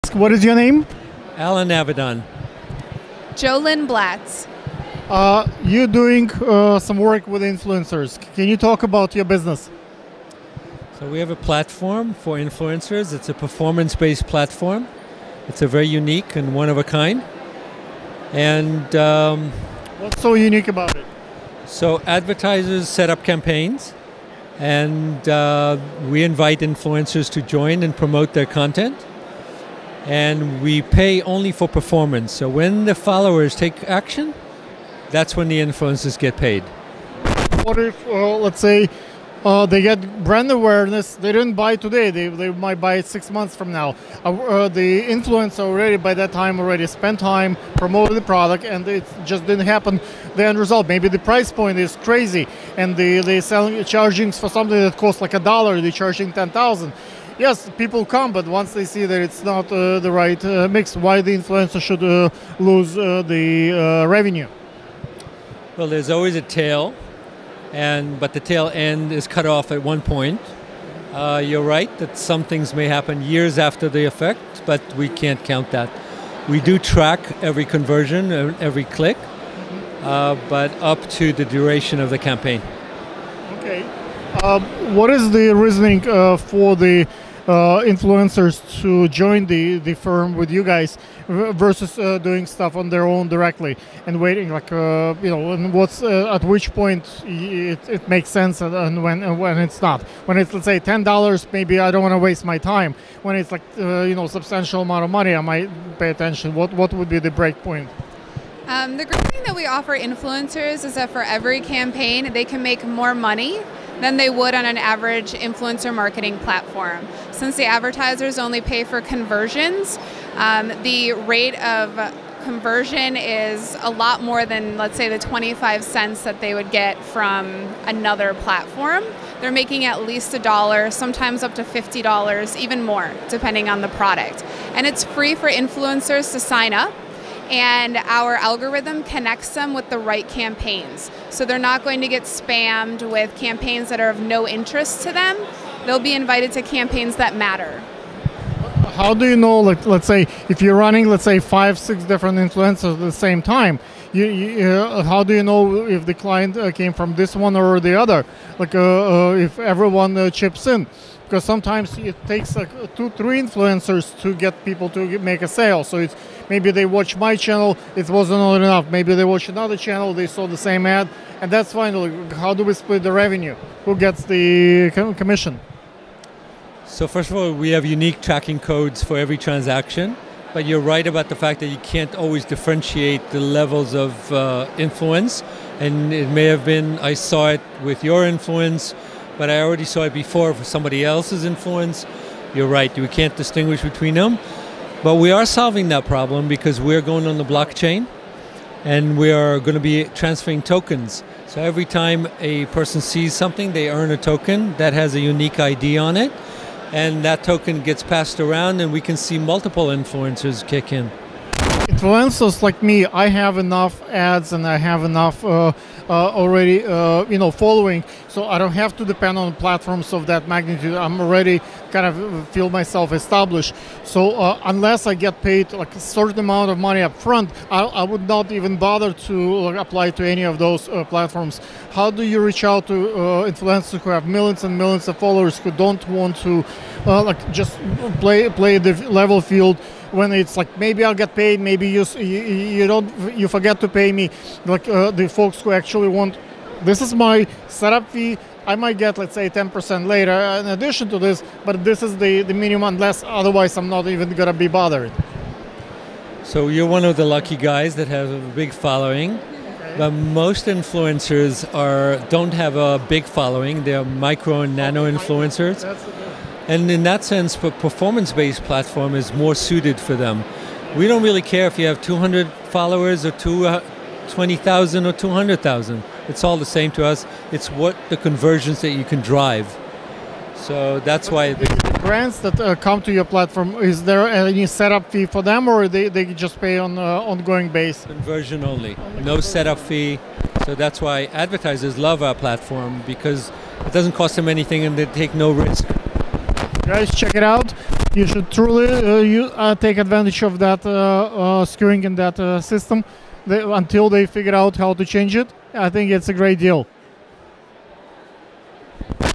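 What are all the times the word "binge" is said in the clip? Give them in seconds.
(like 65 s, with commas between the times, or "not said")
not said.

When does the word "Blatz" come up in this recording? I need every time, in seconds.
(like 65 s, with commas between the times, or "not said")
3 s.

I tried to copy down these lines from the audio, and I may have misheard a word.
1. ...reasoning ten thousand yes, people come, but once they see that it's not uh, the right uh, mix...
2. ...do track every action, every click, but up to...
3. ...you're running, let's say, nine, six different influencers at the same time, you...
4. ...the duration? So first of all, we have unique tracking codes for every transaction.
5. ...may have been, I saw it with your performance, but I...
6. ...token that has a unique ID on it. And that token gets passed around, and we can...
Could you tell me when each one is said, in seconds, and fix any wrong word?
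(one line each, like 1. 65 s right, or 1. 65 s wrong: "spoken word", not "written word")
1. 55 s wrong: "charging", not "reasoning"
2. 76 s wrong: "conversion", not "action"
3. 150 s wrong: "five", not "nine"
4. 174 s wrong: "commission", not "duration"
5. 186 s wrong: "influence", not "performance"
6. 204 s right.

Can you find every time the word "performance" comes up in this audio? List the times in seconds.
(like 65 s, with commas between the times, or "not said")
13 s, 31 s, 267 s.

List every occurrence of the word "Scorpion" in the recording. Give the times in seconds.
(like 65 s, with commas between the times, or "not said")
not said.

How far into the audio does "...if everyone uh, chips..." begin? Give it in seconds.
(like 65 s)
159 s.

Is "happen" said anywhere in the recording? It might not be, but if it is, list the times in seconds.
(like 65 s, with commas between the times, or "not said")
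49 s, 72 s.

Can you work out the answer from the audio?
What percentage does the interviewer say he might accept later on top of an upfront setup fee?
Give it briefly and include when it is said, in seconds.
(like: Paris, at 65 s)
10%, at 249 s.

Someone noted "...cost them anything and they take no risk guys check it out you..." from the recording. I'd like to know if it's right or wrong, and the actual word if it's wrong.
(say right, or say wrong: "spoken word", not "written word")
right.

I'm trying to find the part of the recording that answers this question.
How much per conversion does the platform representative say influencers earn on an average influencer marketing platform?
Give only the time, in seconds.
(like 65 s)
125 s.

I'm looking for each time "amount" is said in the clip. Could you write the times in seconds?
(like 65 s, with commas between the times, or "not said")
104 s, 226 s.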